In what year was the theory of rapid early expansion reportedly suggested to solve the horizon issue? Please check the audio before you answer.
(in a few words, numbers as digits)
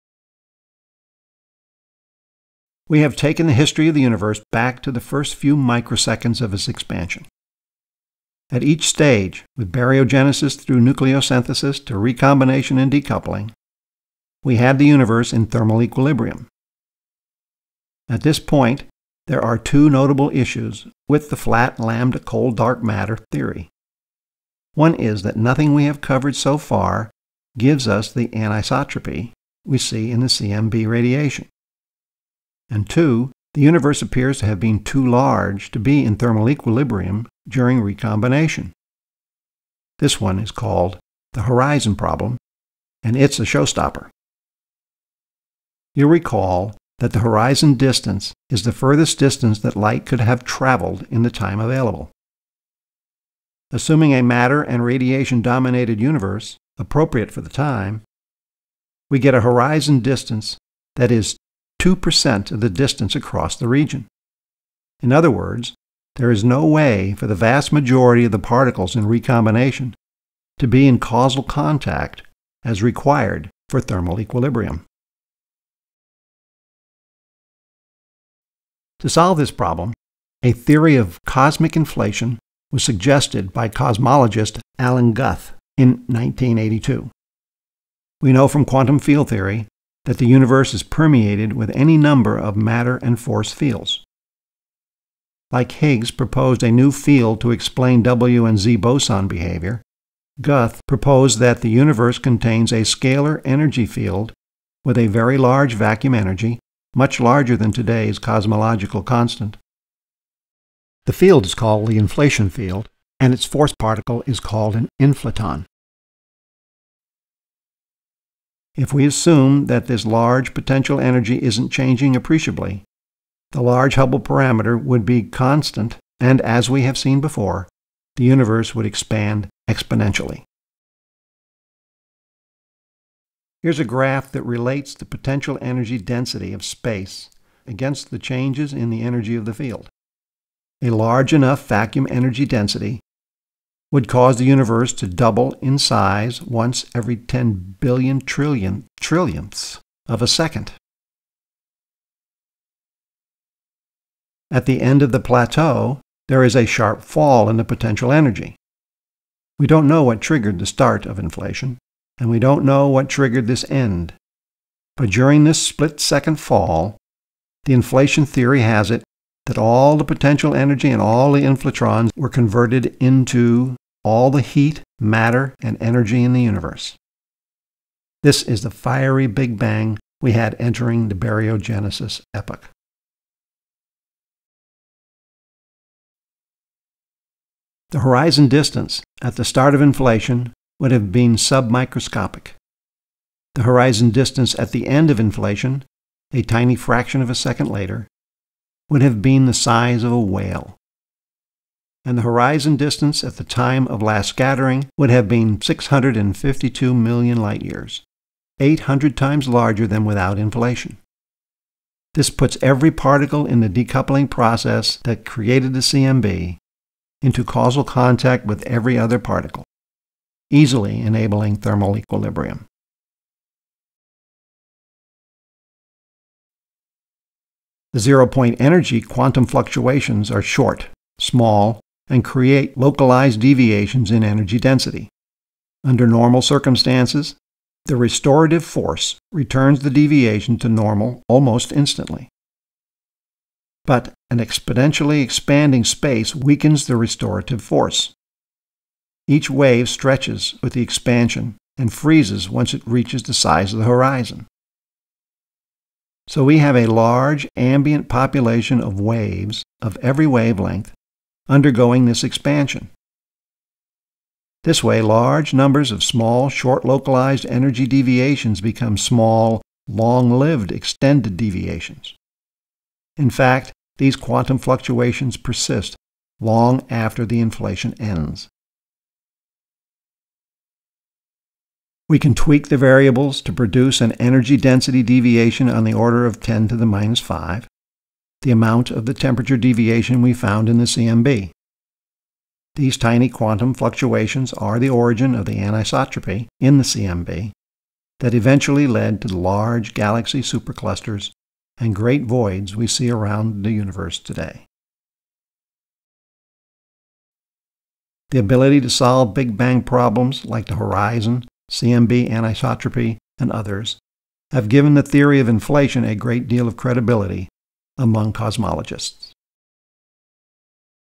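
1982.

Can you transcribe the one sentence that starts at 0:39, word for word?
This one is called the horizon problem, and it's a showstopper.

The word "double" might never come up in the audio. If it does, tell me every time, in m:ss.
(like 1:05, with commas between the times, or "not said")
2:25.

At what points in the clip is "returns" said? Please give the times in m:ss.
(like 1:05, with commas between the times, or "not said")
3:59.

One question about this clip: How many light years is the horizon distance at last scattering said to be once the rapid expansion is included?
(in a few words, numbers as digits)
652 million light years.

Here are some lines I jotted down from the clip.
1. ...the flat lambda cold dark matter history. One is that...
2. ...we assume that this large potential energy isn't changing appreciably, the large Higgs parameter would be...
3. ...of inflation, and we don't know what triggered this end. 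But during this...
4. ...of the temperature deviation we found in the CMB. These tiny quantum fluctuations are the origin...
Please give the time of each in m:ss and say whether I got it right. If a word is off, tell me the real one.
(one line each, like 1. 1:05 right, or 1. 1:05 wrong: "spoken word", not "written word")
1. 0:21 wrong: "theory", not "history"
2. 1:58 wrong: "Hubble", not "Higgs"
3. 2:41 right
4. 4:48 right.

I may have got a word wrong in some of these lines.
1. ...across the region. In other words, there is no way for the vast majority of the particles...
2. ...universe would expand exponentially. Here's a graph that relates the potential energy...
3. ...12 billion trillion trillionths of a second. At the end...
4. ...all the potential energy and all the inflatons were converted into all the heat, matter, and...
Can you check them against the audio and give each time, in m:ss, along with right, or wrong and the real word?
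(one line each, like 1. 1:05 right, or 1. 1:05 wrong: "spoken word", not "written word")
1. 1:03 right
2. 2:08 right
3. 2:27 wrong: "10", not "12"
4. 2:49 right.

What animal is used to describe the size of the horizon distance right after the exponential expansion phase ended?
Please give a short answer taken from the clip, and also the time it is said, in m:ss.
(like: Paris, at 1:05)
whale, at 3:20.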